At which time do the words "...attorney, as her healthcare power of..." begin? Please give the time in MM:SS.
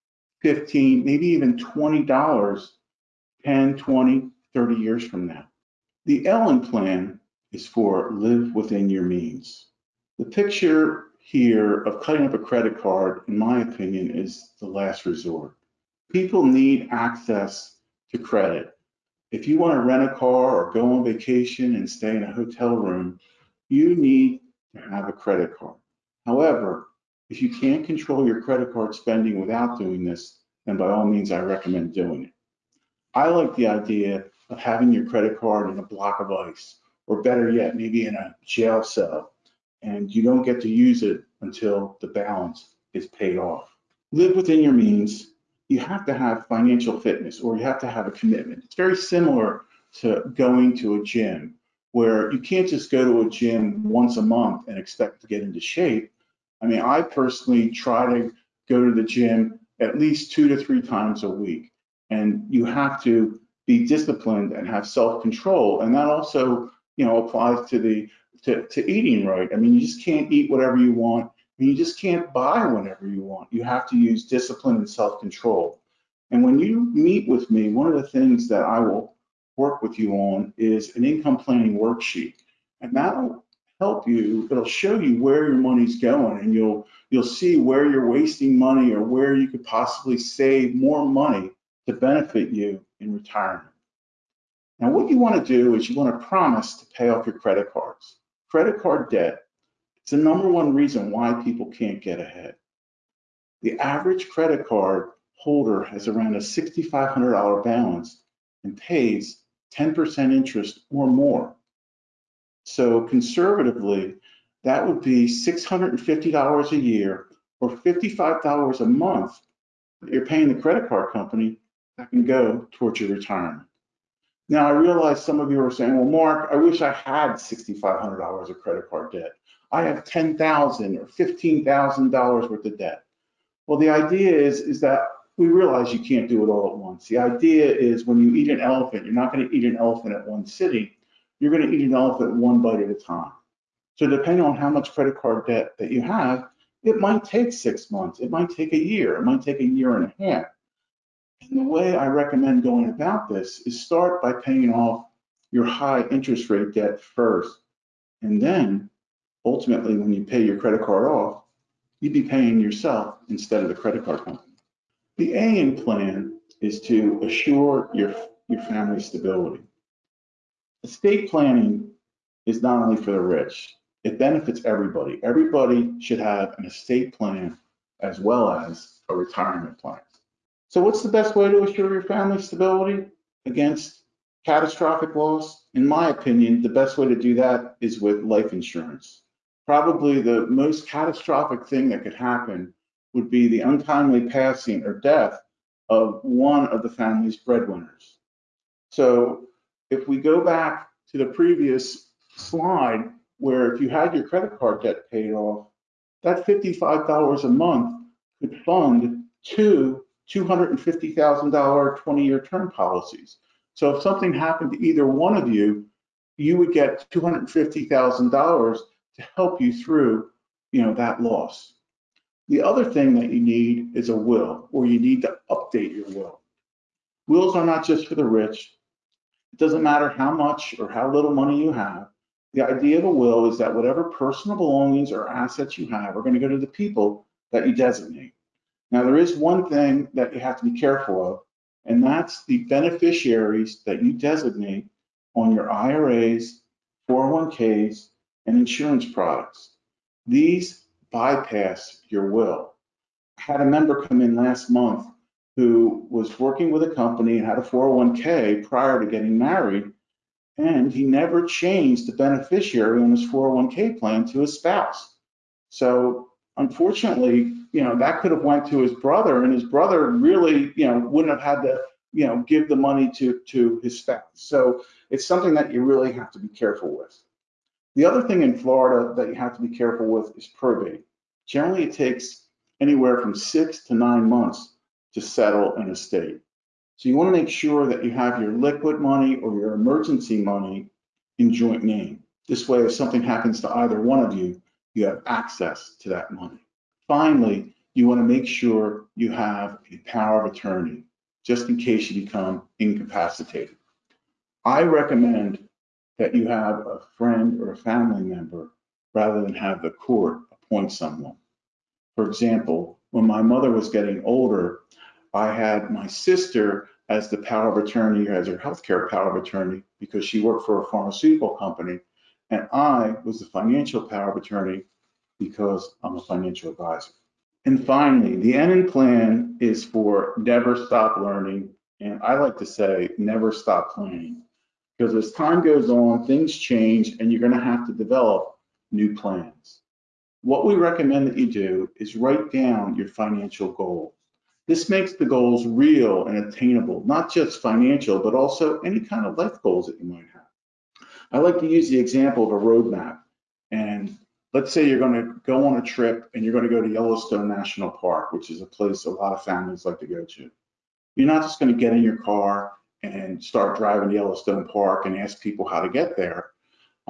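05:17.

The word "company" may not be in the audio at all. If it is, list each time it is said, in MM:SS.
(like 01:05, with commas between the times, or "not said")
02:01, 02:44, 04:16, 05:21.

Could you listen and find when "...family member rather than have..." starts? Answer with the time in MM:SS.
05:07.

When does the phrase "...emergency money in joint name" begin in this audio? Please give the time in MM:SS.
04:49.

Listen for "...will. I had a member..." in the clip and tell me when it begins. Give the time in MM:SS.
04:12.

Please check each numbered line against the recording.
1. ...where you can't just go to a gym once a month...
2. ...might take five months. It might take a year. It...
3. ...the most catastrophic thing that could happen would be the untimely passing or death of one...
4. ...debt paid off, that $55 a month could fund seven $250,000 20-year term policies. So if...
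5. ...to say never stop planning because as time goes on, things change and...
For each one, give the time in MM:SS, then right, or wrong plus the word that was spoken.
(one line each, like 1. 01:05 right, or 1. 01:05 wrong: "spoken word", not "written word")
1. 00:51 right
2. 02:26 wrong: "six", not "five"
3. 03:10 right
4. 03:24 wrong: "two", not "seven"
5. 05:32 right.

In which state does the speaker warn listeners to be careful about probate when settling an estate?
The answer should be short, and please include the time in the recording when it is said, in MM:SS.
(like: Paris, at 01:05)
Florida, at 04:38.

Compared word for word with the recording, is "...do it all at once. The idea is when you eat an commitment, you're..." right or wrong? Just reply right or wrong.
wrong.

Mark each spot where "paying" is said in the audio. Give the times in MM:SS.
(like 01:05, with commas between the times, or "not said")
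02:00, 02:34, 02:42.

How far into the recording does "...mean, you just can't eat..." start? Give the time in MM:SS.
01:09.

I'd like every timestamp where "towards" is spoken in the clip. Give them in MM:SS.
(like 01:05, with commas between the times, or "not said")
02:02.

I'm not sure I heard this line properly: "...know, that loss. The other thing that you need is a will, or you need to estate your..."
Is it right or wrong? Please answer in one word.
wrong.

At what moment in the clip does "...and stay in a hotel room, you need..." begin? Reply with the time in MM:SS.
00:21.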